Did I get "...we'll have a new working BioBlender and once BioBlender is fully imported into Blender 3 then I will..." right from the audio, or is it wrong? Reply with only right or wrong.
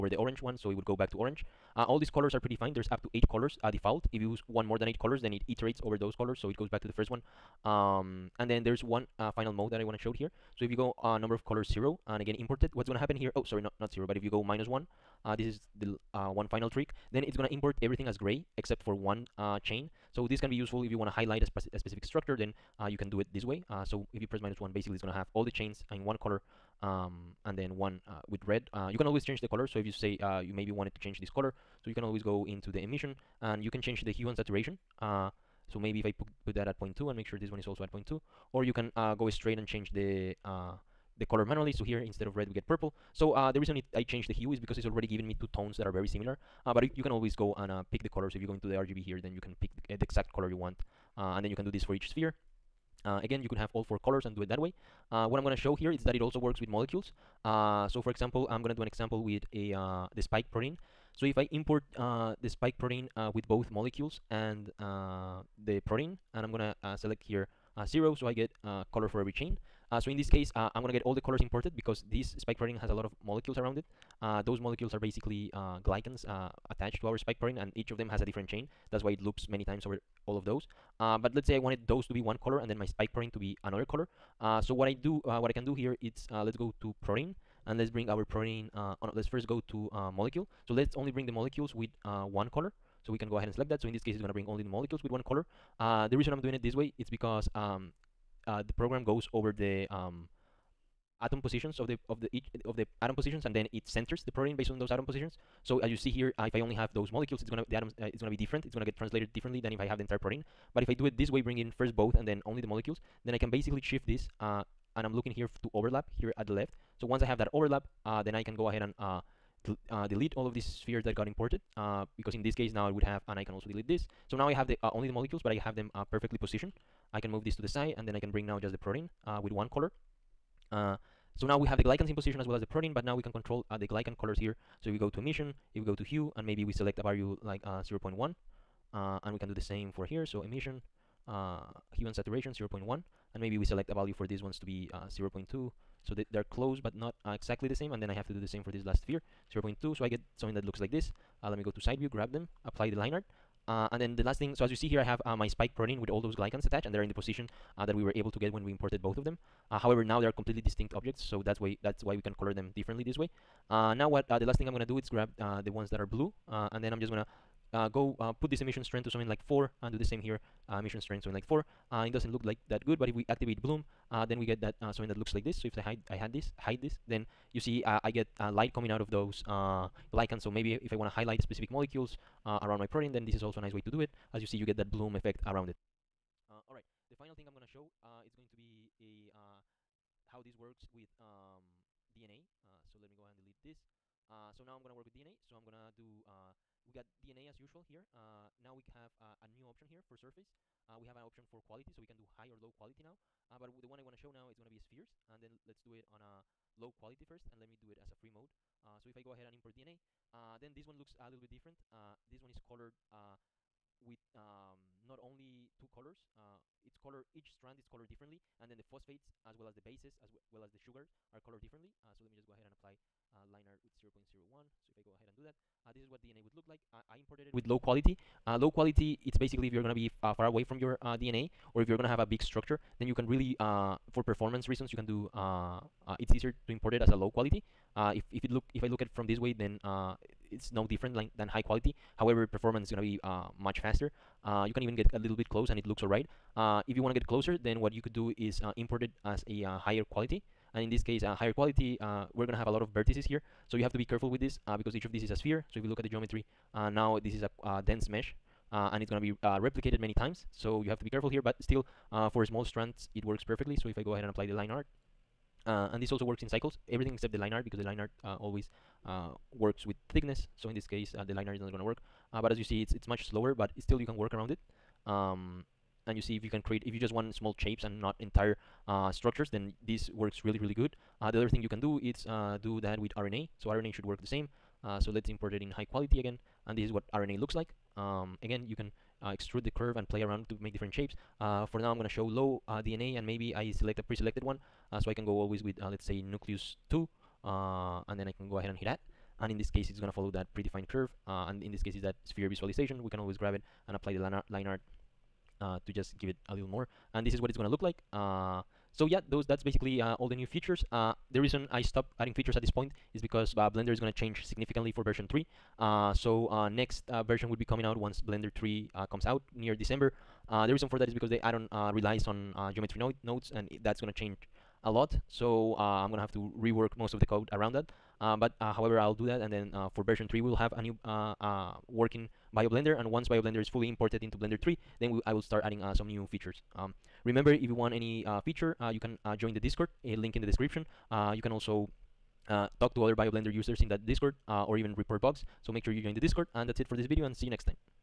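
right.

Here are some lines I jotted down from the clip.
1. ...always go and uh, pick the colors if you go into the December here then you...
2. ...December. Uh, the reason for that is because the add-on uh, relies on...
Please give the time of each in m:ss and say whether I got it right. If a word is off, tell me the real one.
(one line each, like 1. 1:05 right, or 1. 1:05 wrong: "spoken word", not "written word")
1. 0:47 wrong: "RGB", not "December"
2. 5:19 right.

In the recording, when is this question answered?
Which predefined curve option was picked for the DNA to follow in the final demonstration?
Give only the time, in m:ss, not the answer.
4:56.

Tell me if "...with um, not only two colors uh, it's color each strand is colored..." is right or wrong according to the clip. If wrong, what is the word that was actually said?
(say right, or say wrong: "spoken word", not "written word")
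right.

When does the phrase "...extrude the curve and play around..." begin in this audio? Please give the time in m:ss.
4:49.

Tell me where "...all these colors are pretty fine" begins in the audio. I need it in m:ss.
0:01.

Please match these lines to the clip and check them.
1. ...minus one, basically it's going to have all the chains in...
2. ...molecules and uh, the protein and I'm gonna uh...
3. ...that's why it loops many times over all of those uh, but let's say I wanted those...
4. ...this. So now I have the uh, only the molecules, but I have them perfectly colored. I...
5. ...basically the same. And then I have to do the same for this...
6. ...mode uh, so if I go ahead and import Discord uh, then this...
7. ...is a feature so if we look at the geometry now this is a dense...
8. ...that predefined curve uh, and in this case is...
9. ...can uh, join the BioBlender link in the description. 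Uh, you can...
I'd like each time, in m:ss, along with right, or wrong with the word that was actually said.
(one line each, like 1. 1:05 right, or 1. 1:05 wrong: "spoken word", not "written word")
1. 0:24 right
2. 1:03 right
3. 1:18 right
4. 2:03 wrong: "positioned", not "colored"
5. 2:27 wrong: "exactly", not "basically"
6. 3:28 wrong: "DNA", not "Discord"
7. 4:15 wrong: "sphere", not "feature"
8. 5:00 right
9. 5:38 wrong: "Discord", not "BioBlender".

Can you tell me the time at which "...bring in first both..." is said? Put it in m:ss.
1:51.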